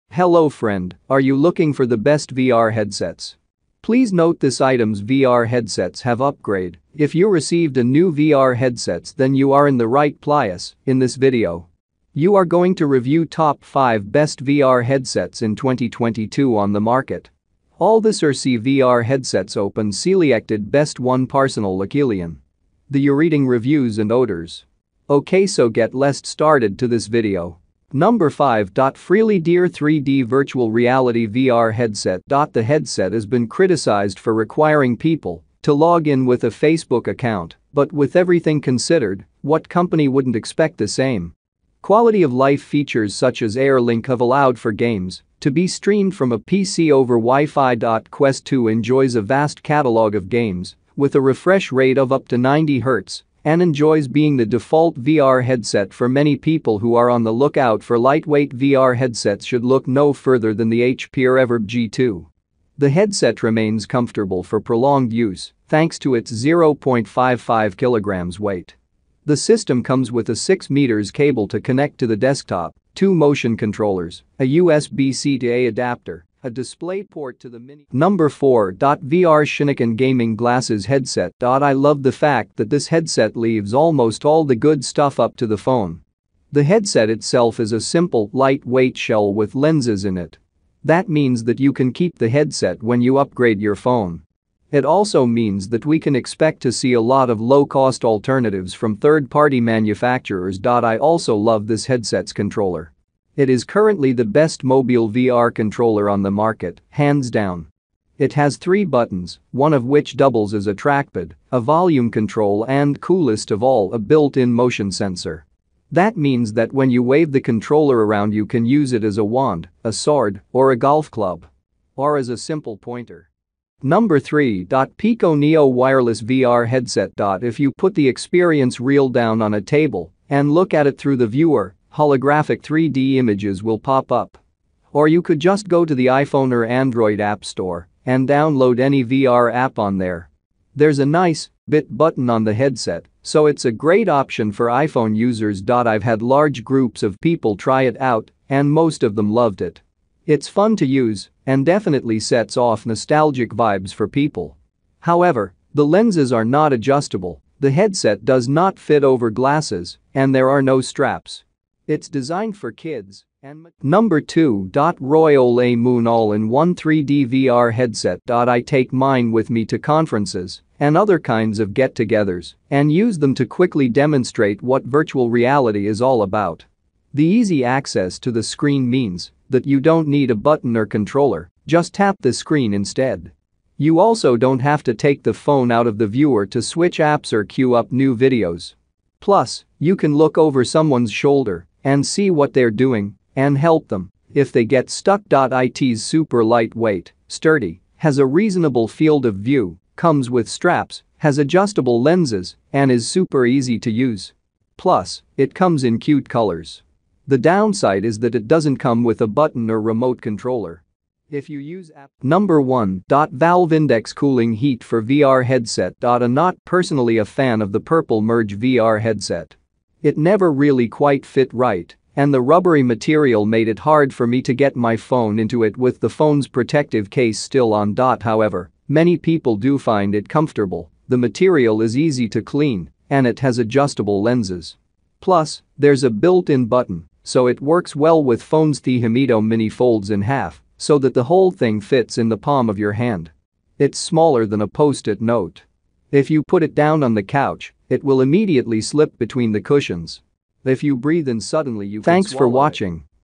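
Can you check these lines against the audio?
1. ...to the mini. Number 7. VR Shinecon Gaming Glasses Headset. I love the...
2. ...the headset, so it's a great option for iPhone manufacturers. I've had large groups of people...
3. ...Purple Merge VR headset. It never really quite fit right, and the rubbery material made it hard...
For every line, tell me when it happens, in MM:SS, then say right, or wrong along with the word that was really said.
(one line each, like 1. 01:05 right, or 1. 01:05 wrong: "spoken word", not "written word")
1. 01:17 wrong: "4", not "7"
2. 02:22 wrong: "users", not "manufacturers"
3. 03:37 right.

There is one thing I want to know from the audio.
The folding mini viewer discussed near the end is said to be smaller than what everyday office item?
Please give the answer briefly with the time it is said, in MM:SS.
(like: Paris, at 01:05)
A post-it note, at 04:04.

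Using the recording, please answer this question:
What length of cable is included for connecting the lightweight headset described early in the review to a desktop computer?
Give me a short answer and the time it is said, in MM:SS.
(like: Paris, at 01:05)
6 meters, at 01:10.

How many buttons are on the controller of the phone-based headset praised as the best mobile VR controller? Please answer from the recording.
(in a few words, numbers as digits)
3.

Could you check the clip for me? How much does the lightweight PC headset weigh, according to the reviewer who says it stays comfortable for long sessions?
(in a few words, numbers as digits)
0.55 kilograms.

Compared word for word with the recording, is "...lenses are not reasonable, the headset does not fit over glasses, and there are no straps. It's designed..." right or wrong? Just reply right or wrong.
wrong.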